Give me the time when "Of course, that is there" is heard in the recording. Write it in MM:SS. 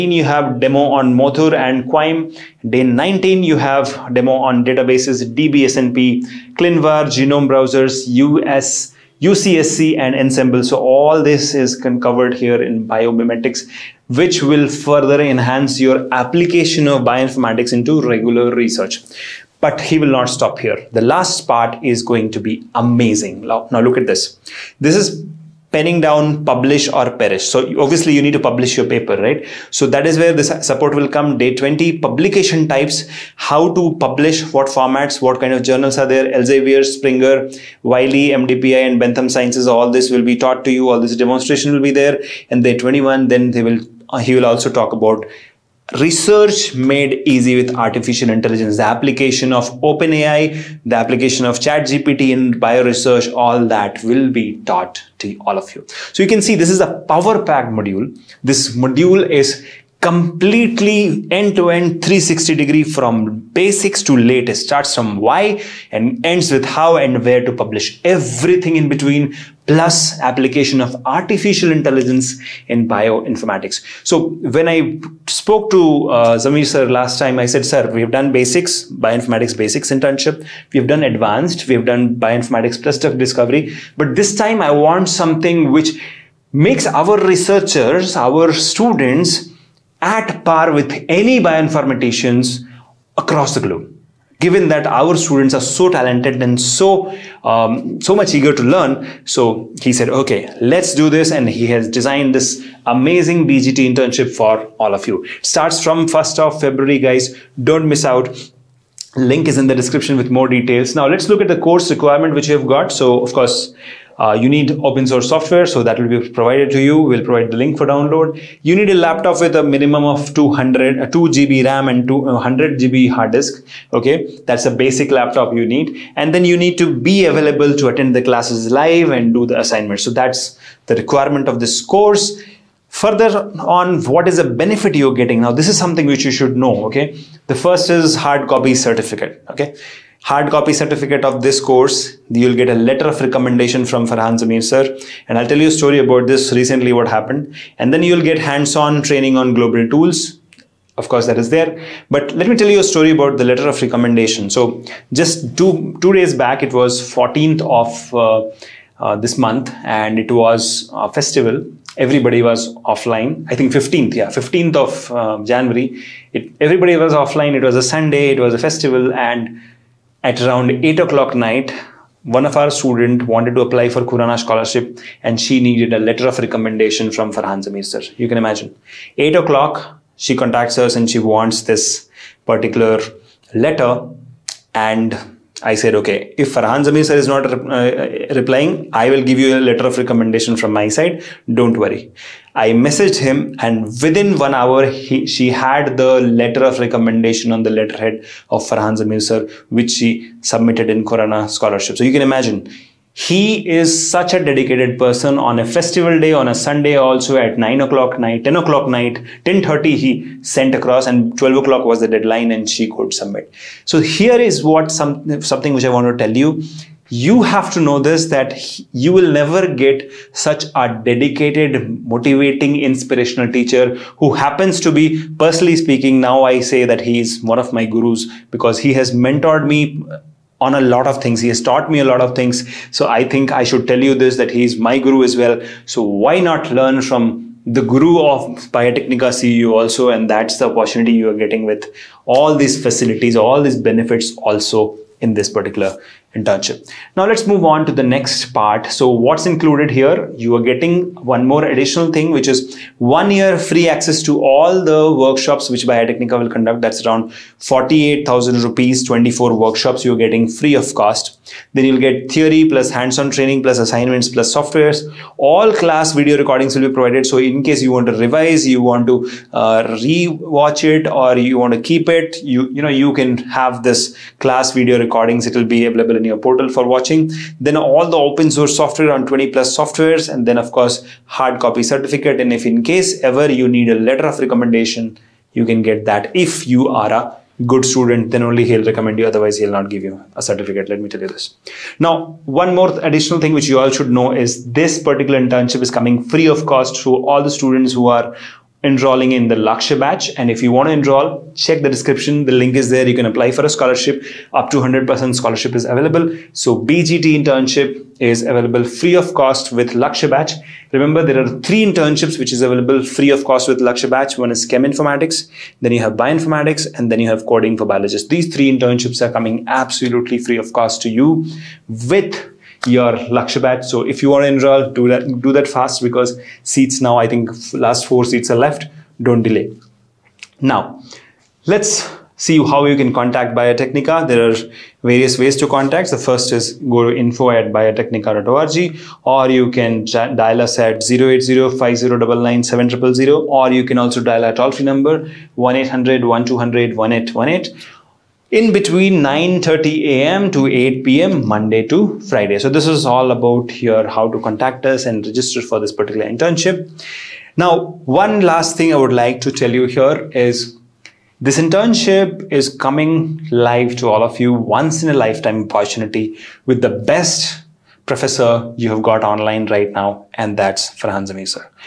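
02:30.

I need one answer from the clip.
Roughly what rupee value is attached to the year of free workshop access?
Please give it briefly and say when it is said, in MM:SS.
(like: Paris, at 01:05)
48,000 rupees, at 04:17.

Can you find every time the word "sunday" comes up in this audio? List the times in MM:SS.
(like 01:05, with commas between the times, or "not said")
02:47, 03:26.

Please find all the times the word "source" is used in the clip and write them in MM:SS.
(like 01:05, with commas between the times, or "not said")
01:55, 04:38.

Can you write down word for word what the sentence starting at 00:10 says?
So all this is covered here in biomimetics, which will further enhance your application of bioinformatics into regular research.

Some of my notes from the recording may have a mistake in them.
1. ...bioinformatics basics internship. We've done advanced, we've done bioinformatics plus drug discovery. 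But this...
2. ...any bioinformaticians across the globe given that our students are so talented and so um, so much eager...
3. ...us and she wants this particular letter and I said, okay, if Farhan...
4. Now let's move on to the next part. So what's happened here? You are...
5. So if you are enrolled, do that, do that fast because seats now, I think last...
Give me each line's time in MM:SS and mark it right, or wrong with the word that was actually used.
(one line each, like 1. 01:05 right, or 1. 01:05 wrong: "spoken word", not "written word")
1. 01:18 right
2. 01:31 right
3. 03:00 right
4. 04:07 wrong: "included", not "happened"
5. 05:23 right.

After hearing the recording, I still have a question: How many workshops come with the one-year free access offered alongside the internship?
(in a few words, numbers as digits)
24.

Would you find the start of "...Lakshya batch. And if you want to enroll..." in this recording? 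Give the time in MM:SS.
04:59.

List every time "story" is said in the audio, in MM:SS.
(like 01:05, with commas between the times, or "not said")
02:25, 02:32.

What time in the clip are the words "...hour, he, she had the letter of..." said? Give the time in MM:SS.
03:14.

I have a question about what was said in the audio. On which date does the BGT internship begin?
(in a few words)
1st of February.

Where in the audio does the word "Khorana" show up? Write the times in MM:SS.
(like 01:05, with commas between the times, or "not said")
02:54, 03:21.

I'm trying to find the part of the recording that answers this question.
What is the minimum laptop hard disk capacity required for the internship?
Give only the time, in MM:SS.
02:02.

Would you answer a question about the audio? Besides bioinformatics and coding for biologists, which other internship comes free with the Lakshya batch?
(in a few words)
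Chem Informatics.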